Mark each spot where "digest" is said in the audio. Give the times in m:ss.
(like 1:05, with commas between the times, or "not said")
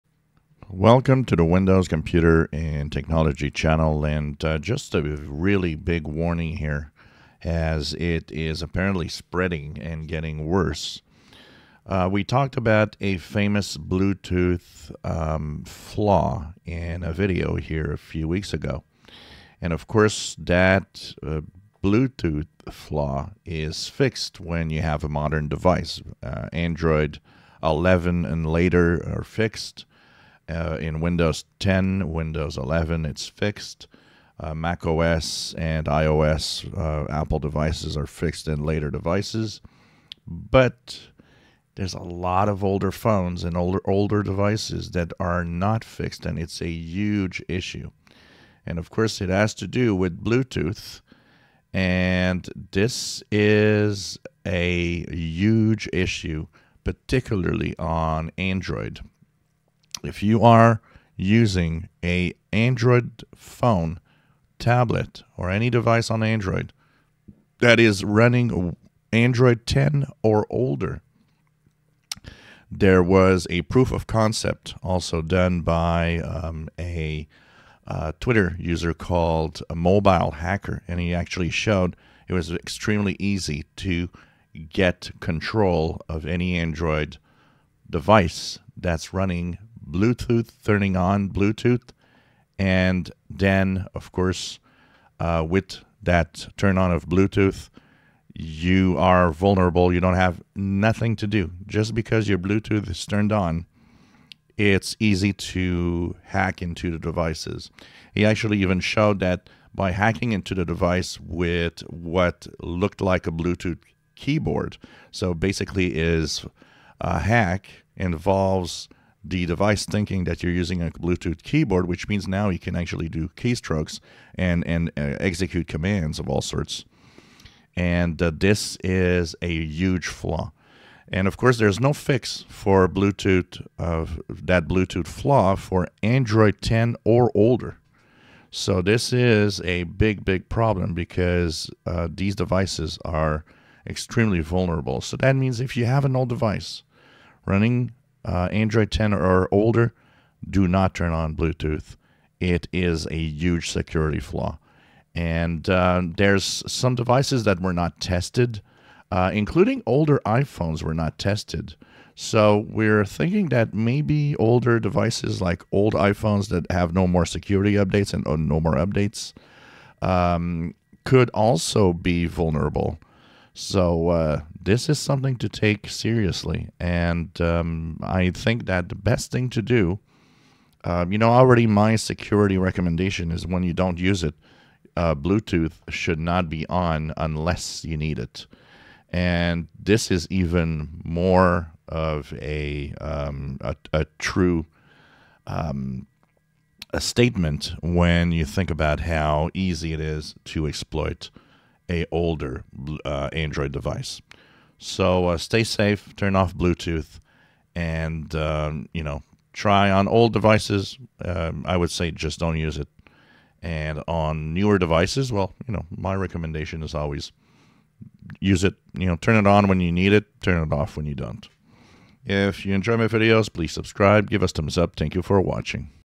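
not said.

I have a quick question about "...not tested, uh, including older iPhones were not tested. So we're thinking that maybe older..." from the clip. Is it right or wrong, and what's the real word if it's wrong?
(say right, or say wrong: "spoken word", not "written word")
right.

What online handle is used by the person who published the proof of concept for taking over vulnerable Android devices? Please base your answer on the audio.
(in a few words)
Mobile Hacker.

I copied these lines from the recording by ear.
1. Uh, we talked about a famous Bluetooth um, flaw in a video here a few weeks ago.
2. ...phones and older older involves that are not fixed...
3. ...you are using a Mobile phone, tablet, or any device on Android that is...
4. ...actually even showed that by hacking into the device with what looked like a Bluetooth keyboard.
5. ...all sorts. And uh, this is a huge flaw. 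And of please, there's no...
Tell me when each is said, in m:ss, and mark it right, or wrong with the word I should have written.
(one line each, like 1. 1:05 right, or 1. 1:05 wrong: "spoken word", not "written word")
1. 0:11 right
2. 0:42 wrong: "devices", not "involves"
3. 1:00 wrong: "Android", not "Mobile"
4. 1:48 right
5. 2:06 wrong: "course", not "please".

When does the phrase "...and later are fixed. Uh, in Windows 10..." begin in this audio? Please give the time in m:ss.
0:28.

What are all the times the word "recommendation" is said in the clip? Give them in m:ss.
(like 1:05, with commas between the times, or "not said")
3:02, 3:36.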